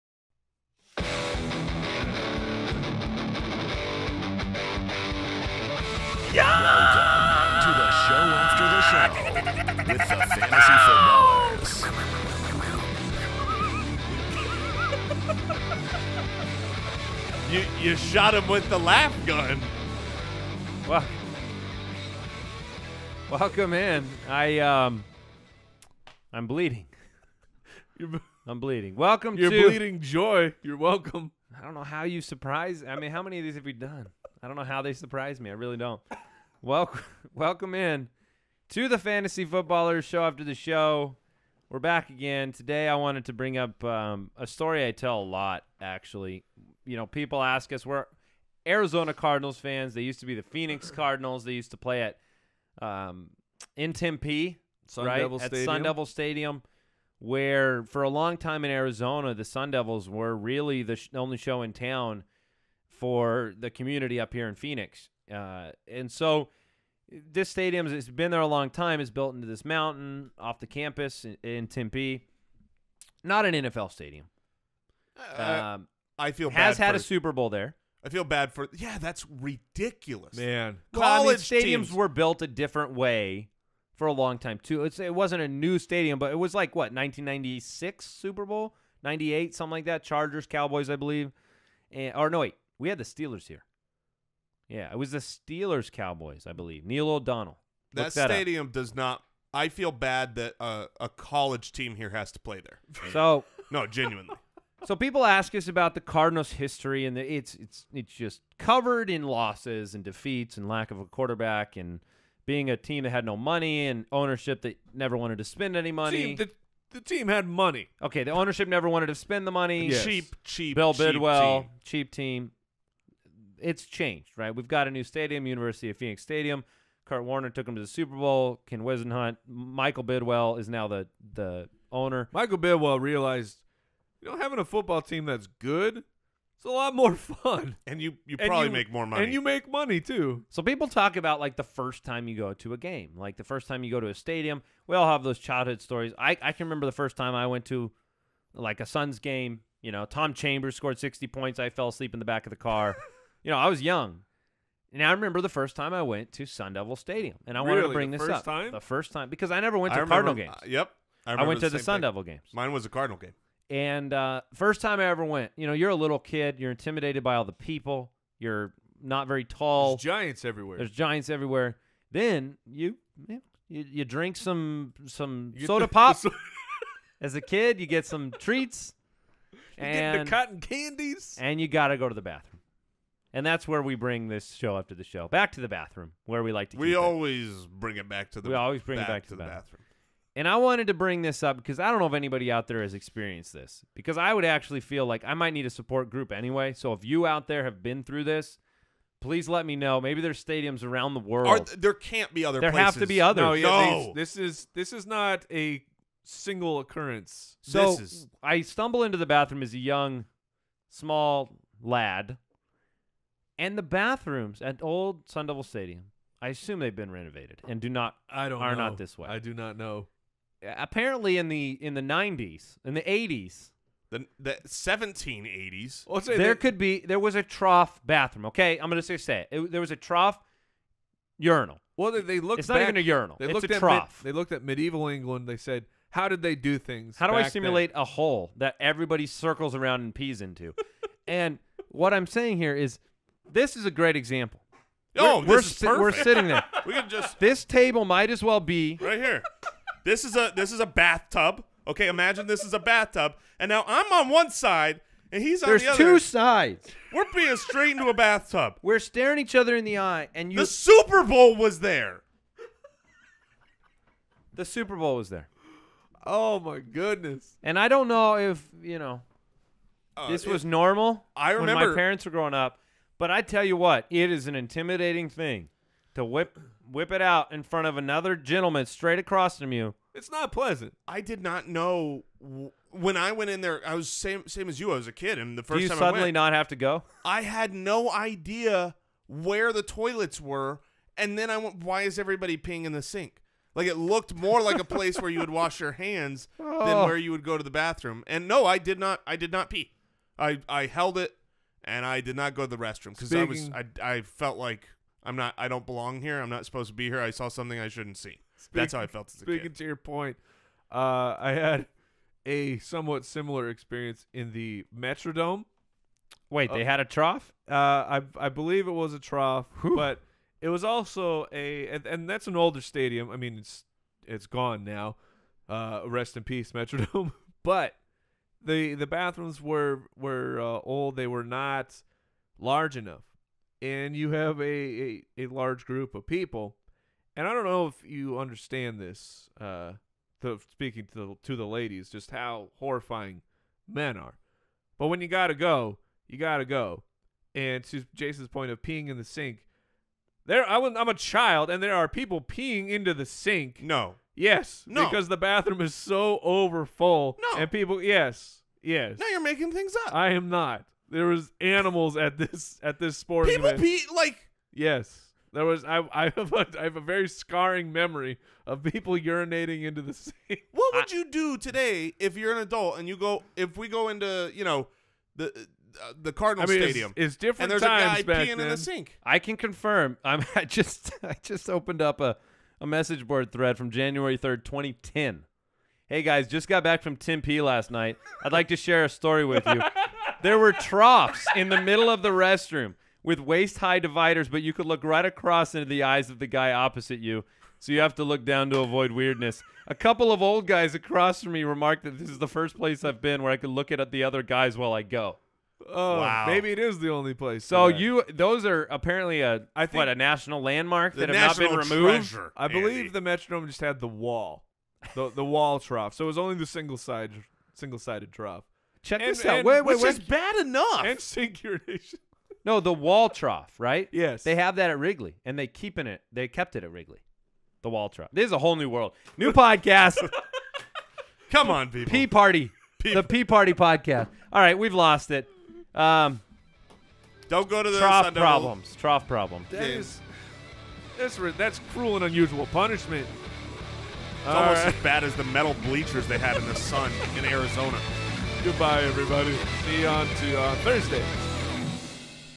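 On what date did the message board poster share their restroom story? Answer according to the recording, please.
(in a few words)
January 3, 2010.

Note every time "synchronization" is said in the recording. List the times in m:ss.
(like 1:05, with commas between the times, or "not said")
7:01.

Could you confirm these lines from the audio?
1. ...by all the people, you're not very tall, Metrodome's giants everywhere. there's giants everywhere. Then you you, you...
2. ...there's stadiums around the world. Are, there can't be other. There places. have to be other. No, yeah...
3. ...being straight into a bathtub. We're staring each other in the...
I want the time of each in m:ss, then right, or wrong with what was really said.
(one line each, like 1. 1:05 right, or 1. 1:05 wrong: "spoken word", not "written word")
1. 2:47 wrong: "There", not "Metrodome"
2. 3:20 right
3. 4:17 right.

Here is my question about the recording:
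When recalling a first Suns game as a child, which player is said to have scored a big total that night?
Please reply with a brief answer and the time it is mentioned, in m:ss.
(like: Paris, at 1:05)
Tom Chambers, at 2:30.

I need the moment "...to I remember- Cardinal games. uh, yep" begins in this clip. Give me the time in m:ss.
2:39.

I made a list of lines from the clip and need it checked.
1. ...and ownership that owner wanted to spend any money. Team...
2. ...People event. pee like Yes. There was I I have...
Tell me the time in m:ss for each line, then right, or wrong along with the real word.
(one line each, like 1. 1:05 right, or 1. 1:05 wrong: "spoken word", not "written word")
1. 1:53 wrong: "never", not "owner"
2. 6:03 right.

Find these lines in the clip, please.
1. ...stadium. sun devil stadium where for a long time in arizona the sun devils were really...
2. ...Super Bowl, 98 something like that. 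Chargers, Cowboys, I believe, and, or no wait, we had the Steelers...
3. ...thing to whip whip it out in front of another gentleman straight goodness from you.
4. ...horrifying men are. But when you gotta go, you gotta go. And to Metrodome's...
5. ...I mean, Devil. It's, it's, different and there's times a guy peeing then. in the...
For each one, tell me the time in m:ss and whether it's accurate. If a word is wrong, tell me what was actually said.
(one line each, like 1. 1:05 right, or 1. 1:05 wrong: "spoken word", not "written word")
1. 0:55 right
2. 1:28 right
3. 4:35 wrong: "across", not "goodness"
4. 5:42 wrong: "Jason", not "Metrodome"
5. 6:16 wrong: "Stadium", not "Devil".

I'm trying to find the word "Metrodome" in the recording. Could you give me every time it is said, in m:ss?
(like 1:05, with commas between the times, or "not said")
5:14, 5:26, 6:53.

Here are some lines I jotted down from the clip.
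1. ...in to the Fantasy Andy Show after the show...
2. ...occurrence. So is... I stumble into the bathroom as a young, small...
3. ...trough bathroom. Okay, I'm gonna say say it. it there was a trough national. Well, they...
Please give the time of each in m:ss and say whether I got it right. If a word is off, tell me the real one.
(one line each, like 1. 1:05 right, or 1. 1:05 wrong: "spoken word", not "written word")
1. 0:37 wrong: "Footballers", not "Andy"
2. 3:26 right
3. 3:47 wrong: "urinal", not "national".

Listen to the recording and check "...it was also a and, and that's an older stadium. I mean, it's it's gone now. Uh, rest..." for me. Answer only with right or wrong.
right.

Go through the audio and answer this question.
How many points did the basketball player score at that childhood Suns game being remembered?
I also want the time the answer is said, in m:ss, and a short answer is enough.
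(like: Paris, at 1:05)
60, at 2:30.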